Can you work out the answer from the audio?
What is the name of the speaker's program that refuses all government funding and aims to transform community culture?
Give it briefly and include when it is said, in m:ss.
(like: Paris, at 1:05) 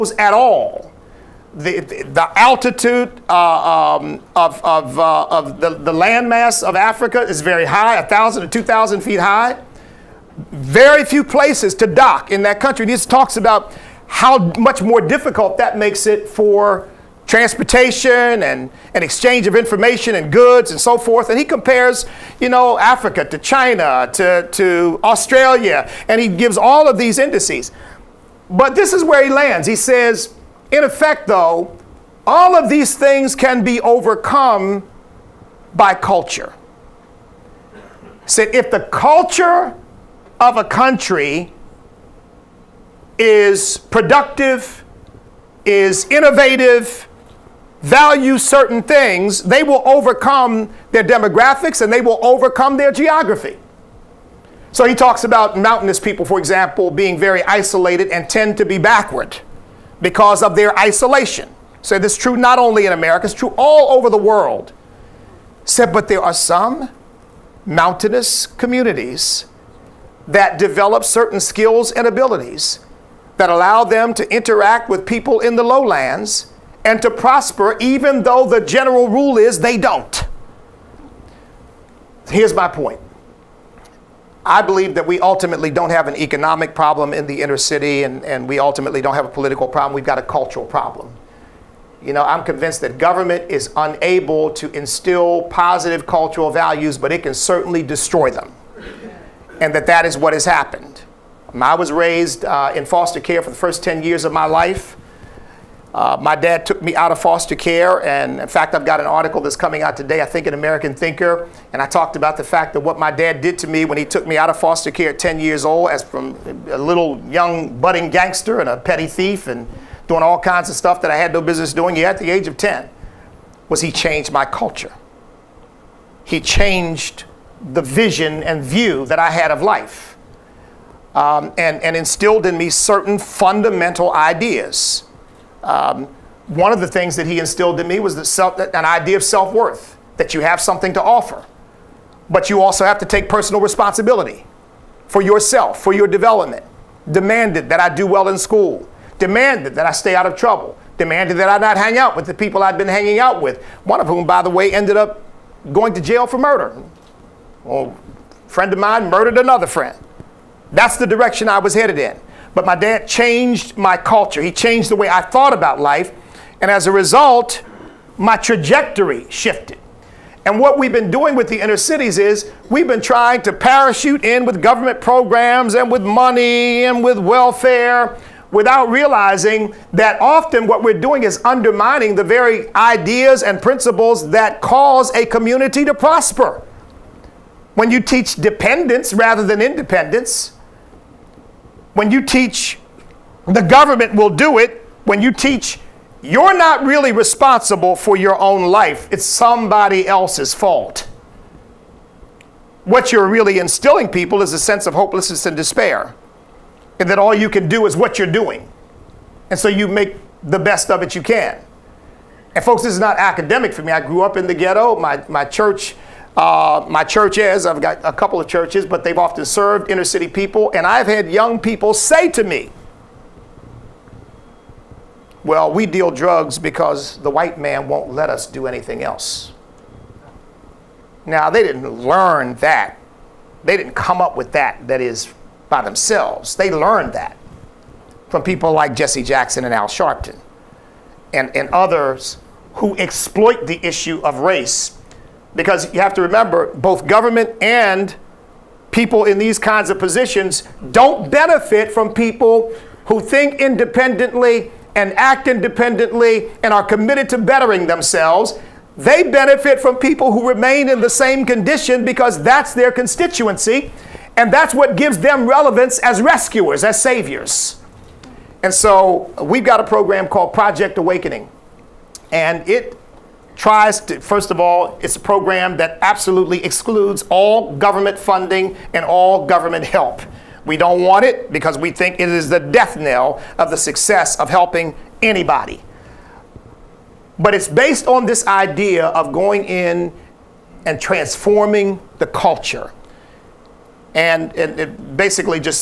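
Project Awakening, at 4:30.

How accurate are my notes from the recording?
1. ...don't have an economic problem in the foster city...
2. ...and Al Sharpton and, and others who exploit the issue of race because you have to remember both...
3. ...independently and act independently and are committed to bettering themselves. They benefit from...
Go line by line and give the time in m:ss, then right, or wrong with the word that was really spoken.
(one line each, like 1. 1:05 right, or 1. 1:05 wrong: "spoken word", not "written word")
1. 1:25 wrong: "inner", not "foster"
2. 3:59 right
3. 4:13 right.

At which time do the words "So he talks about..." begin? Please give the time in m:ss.
0:54.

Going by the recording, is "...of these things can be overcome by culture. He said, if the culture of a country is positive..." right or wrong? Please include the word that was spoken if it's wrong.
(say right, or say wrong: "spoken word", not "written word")
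wrong: "productive", not "positive".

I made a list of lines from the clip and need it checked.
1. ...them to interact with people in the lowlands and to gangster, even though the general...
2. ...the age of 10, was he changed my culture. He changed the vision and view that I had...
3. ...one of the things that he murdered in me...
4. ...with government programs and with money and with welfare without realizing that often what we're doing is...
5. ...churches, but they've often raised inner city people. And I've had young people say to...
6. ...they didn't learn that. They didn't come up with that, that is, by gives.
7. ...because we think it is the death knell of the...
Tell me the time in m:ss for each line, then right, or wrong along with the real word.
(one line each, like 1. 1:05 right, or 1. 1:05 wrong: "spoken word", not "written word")
1. 1:13 wrong: "prosper", not "gangster"
2. 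2:02 right
3. 2:16 wrong: "instilled", not "murdered"
4. 2:54 right
5. 3:38 wrong: "served", not "raised"
6. 3:51 wrong: "themselves", not "gives"
7. 4:41 right.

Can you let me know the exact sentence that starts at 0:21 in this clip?
And he compares, you know, Africa to China to, to Australia, and he gives all of these indices.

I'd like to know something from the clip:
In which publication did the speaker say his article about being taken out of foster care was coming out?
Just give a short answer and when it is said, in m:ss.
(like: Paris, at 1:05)
American Thinker, at 1:50.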